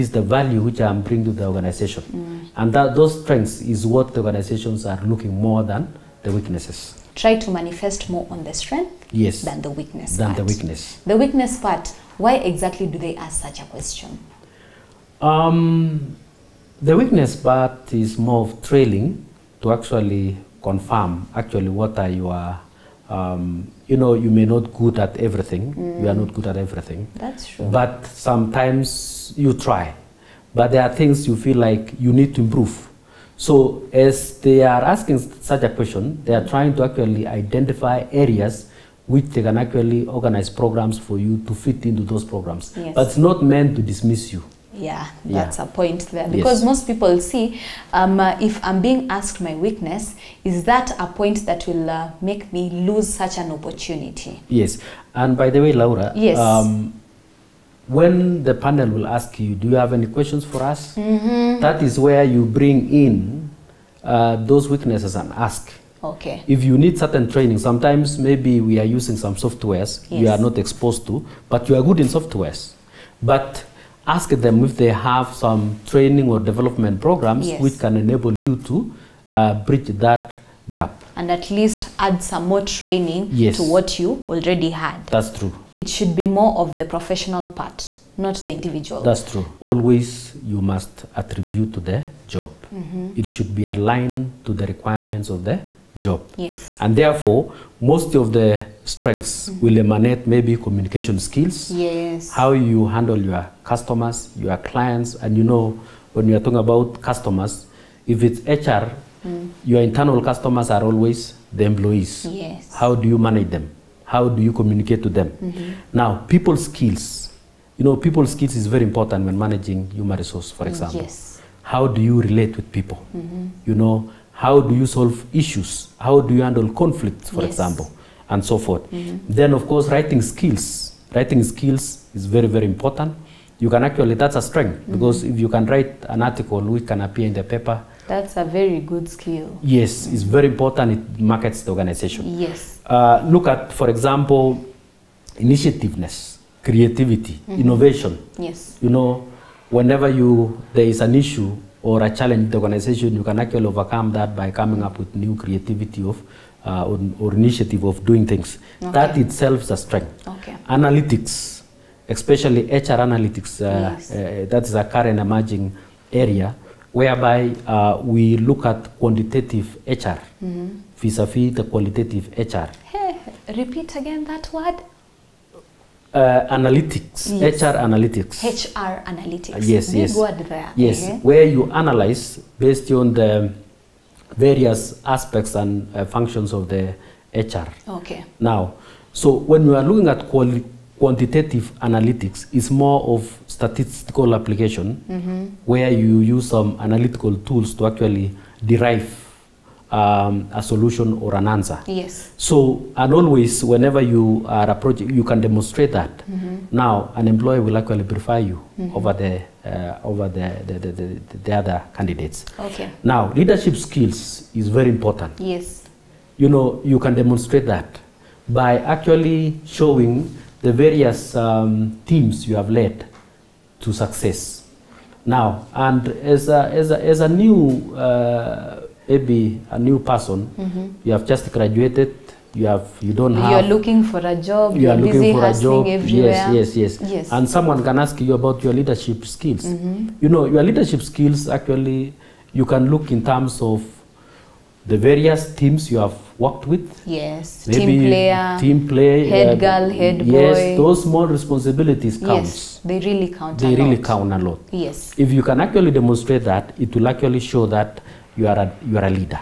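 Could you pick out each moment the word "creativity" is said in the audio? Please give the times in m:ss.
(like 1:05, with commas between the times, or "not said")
2:26, 2:35.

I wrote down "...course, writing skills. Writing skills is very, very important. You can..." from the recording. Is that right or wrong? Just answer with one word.
right.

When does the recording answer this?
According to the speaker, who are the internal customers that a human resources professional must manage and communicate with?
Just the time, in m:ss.
1:51.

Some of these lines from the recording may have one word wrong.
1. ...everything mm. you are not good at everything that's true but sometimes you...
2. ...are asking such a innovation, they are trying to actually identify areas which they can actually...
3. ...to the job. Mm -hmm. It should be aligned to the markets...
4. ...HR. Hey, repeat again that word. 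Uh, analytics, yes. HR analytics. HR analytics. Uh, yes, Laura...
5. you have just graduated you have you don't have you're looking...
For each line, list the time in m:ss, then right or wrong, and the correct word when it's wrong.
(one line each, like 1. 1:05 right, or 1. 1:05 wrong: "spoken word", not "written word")
1. 0:25 right
2. 0:34 wrong: "question", not "innovation"
3. 1:31 wrong: "requirements", not "markets"
4. 2:52 wrong: "Big", not "Laura"
5. 3:51 right.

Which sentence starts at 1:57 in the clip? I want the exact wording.
You know, people skills is very important when managing human resource, for mm, example.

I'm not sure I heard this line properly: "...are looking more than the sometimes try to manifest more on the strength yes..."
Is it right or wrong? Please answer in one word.
wrong.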